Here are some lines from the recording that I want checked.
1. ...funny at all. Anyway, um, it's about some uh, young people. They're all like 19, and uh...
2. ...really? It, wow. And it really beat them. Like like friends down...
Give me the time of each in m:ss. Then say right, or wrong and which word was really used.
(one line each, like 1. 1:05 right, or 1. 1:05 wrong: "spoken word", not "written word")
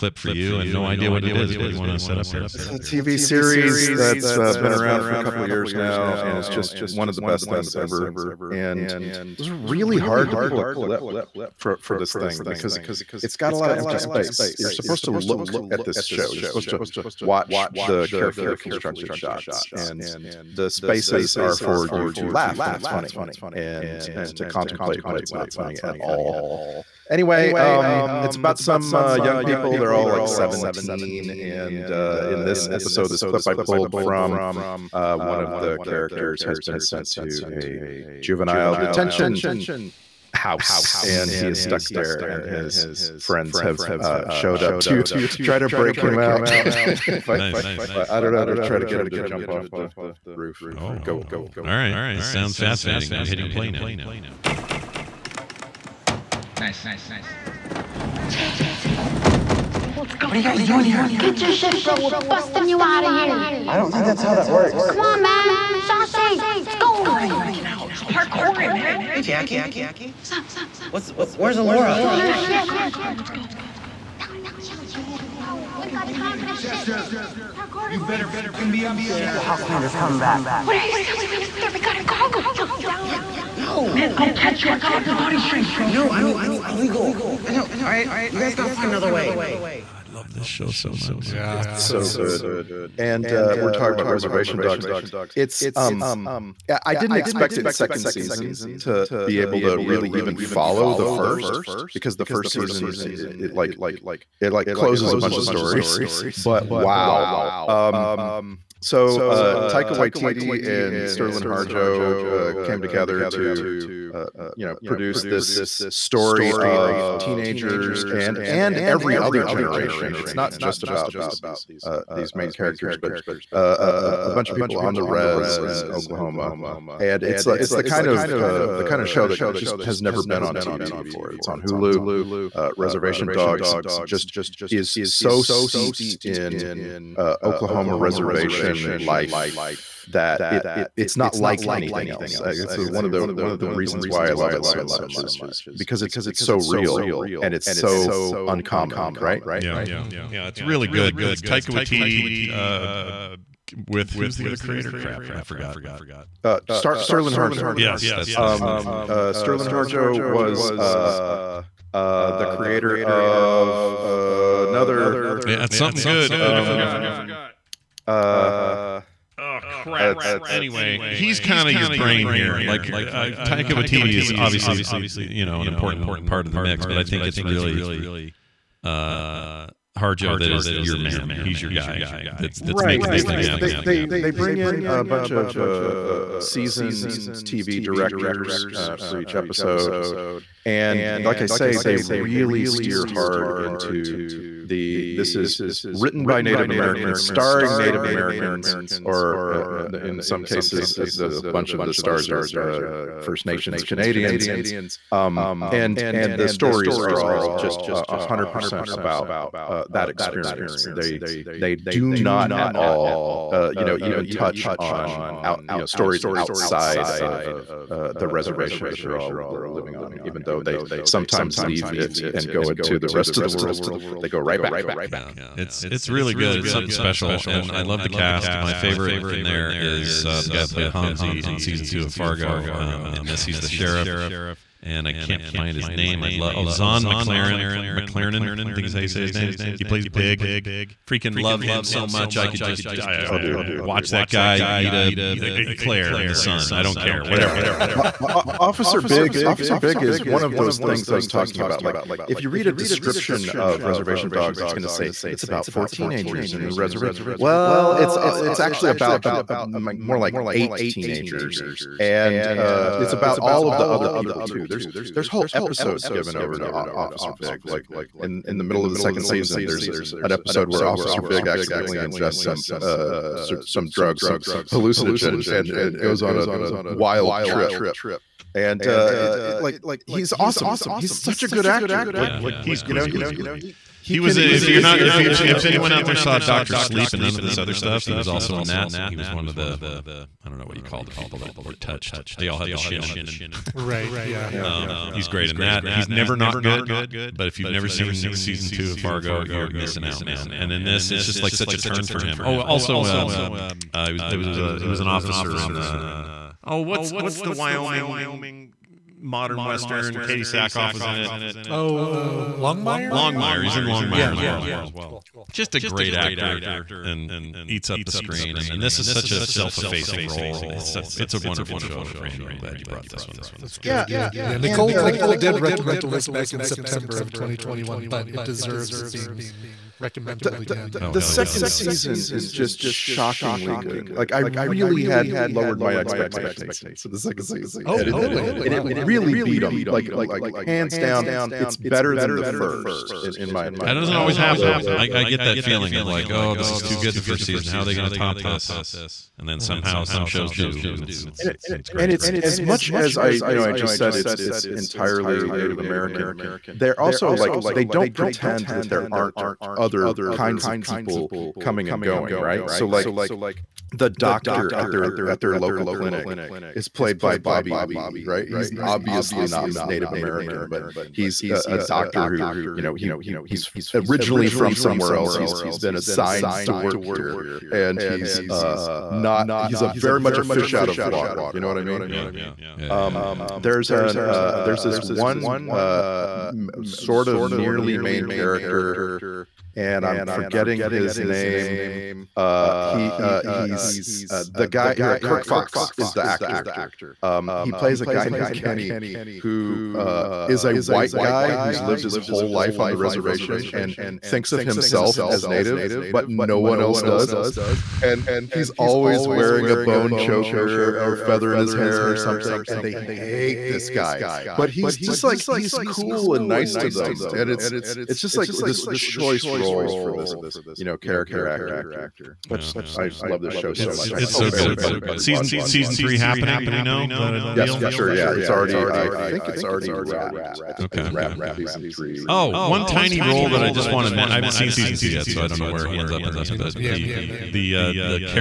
1. 0:25 wrong: "17", not "19"
2. 5:38 wrong: "hands", not "friends".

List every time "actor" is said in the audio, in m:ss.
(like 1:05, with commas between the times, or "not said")
4:41, 5:16, 6:36, 7:01.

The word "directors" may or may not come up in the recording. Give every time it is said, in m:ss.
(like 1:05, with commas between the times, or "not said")
3:07.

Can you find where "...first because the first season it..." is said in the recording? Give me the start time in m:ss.
1:41.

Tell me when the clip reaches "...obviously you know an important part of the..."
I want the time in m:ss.
2:54.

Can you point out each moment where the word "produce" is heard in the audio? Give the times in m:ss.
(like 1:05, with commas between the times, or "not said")
1:54.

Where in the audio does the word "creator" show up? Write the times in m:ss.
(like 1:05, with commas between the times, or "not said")
2:34, 2:42.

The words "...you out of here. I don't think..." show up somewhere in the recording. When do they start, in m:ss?
1:02.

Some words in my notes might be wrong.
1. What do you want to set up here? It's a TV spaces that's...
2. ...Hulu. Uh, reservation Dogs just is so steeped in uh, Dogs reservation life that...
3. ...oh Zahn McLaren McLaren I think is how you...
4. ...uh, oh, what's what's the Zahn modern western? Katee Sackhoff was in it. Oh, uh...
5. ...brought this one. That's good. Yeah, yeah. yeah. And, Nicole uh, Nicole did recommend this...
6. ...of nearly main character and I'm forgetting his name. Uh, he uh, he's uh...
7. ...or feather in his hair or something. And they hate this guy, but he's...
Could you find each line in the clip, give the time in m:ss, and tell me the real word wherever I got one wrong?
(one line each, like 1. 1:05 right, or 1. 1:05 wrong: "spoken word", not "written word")
1. 0:01 wrong: "series", not "spaces"
2. 2:11 wrong: "Oklahoma", not "Dogs"
3. 3:56 right
4. 5:05 wrong: "Wyoming", not "Zahn"
5. 5:22 right
6. 6:27 right
7. 6:50 right.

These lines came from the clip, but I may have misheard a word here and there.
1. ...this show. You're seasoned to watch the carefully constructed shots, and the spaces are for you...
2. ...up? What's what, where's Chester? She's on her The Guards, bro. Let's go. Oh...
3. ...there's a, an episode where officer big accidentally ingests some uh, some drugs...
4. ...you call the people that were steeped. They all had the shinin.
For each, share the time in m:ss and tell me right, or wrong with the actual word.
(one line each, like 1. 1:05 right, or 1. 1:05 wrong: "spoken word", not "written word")
1. 0:15 wrong: "supposed", not "seasoned"
2. 1:10 wrong: "Elora", not "Chester"
3. 4:29 right
4. 4:50 wrong: "touched", not "steeped".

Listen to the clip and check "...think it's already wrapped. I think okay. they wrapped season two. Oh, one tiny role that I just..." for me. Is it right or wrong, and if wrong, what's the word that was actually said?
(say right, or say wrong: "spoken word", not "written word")
wrong: "three", not "two".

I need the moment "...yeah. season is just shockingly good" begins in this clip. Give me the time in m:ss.
5:31.